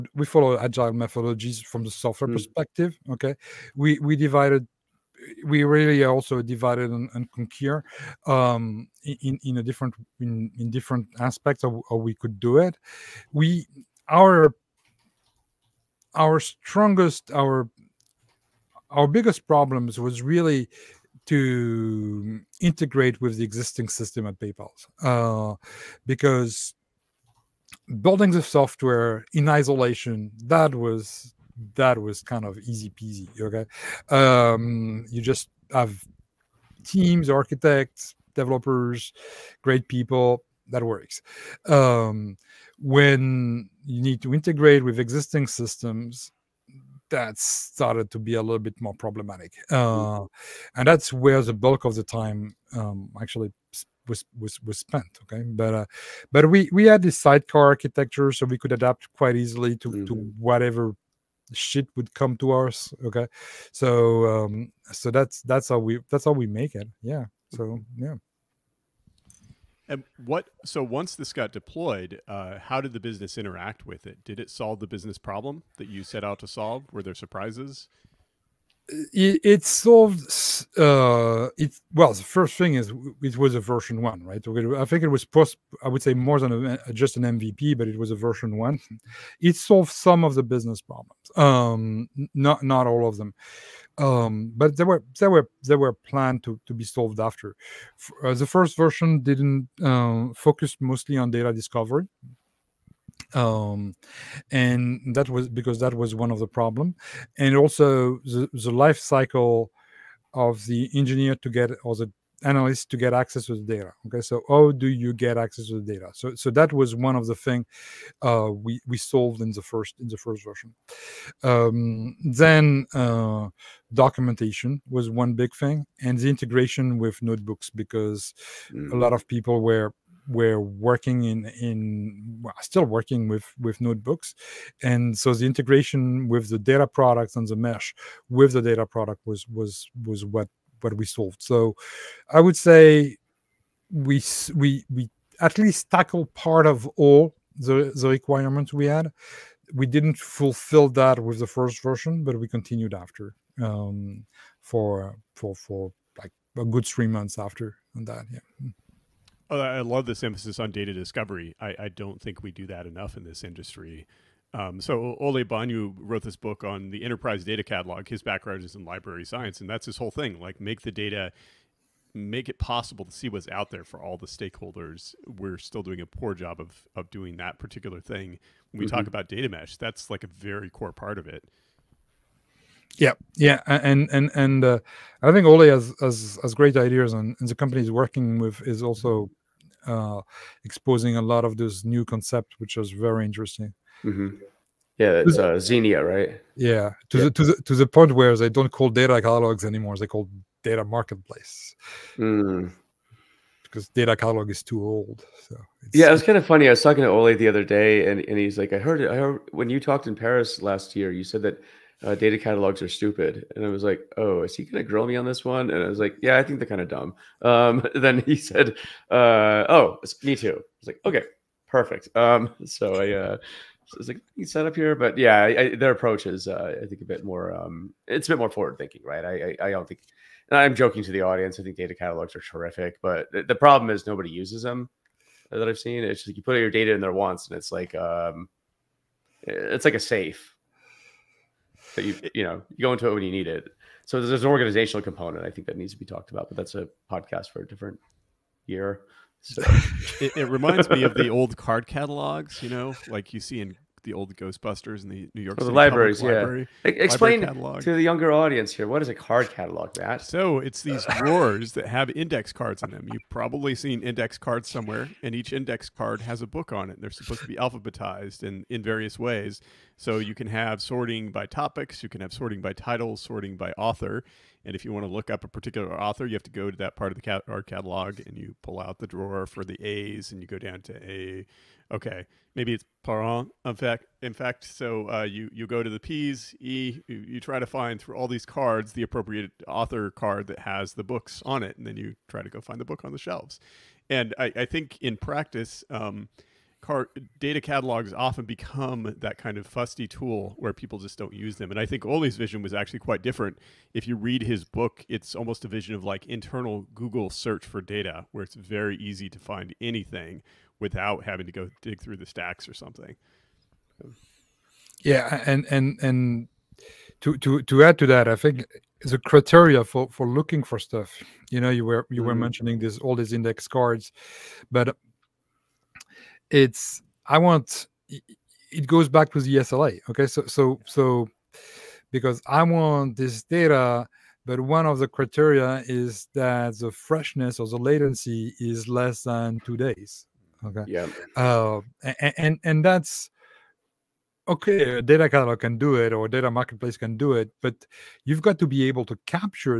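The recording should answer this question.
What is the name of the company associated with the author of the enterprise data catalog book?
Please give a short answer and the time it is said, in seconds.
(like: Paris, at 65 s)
Zeenea, at 195 s.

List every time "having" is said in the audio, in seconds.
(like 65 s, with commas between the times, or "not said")
311 s.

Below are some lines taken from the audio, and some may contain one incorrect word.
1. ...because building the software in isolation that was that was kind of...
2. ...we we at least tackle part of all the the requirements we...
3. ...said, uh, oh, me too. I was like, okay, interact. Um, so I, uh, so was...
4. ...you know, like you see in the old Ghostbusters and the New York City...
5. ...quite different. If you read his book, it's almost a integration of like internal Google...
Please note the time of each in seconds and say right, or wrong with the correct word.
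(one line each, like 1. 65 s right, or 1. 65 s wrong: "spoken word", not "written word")
1. 26 s right
2. 144 s right
3. 218 s wrong: "perfect", not "interact"
4. 252 s right
5. 303 s wrong: "vision", not "integration".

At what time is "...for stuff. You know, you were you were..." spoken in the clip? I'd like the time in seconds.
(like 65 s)
320 s.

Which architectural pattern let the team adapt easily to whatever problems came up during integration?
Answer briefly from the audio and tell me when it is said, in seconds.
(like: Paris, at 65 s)
Sidecar architecture, at 57 s.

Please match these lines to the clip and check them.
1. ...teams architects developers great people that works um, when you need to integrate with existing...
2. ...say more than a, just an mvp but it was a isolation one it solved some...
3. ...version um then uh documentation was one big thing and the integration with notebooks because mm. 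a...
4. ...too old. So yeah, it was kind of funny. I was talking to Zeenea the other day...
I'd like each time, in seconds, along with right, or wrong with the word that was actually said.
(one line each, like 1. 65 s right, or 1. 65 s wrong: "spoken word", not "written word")
1. 36 s right
2. 86 s wrong: "version", not "isolation"
3. 120 s right
4. 204 s wrong: "Ole", not "Zeenea".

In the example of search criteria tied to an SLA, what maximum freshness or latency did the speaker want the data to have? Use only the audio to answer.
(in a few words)
Less than 2 days.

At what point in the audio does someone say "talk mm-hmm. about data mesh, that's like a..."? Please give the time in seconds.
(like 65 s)
178 s.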